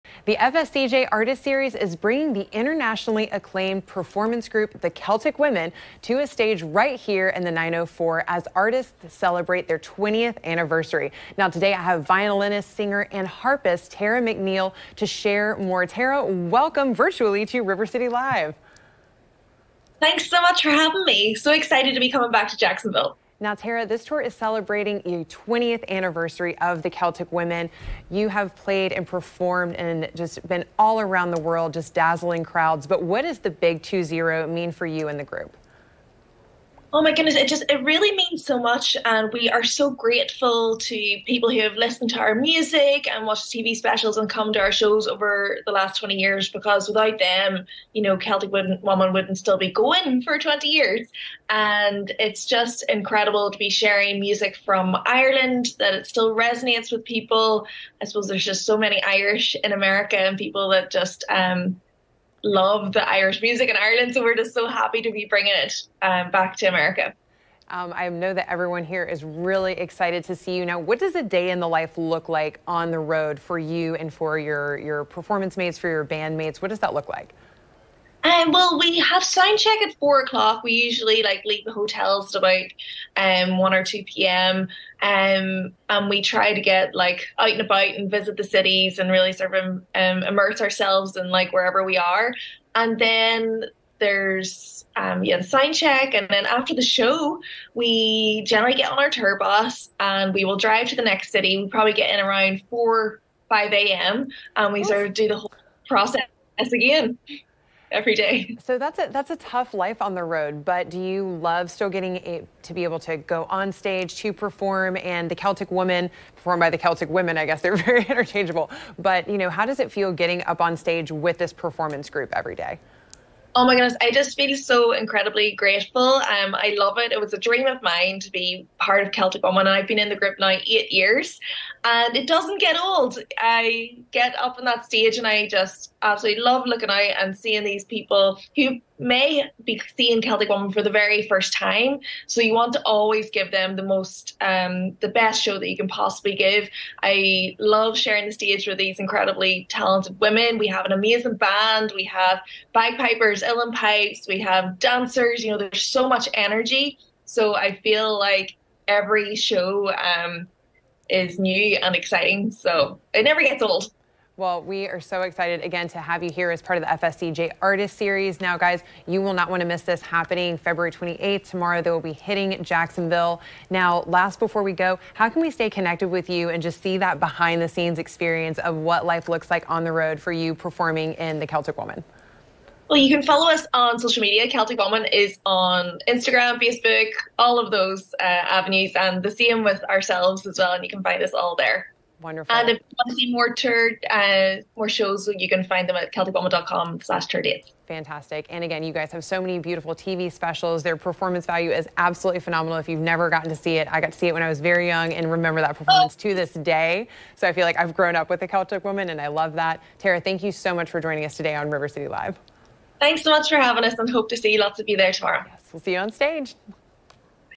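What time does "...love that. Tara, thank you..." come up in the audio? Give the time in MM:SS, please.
03:29.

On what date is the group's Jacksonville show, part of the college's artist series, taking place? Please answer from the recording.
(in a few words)
February 28.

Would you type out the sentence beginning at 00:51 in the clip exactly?
And it's just incredible to be sharing music from Ireland that it still resonates with people.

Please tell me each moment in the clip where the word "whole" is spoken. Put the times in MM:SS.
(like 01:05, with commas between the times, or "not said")
01:45.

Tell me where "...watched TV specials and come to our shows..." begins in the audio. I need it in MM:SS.
00:43.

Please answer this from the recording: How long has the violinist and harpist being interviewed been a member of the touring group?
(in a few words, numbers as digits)
8 years.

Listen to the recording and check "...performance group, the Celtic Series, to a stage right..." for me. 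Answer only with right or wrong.
wrong.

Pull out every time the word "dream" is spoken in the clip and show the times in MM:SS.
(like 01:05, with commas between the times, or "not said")
02:07.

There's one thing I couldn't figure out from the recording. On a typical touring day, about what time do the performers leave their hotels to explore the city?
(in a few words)
1 or 2 p.m.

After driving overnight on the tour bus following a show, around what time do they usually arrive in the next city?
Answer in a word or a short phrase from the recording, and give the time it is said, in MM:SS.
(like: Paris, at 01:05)
4 or 5 a.m., at 01:42.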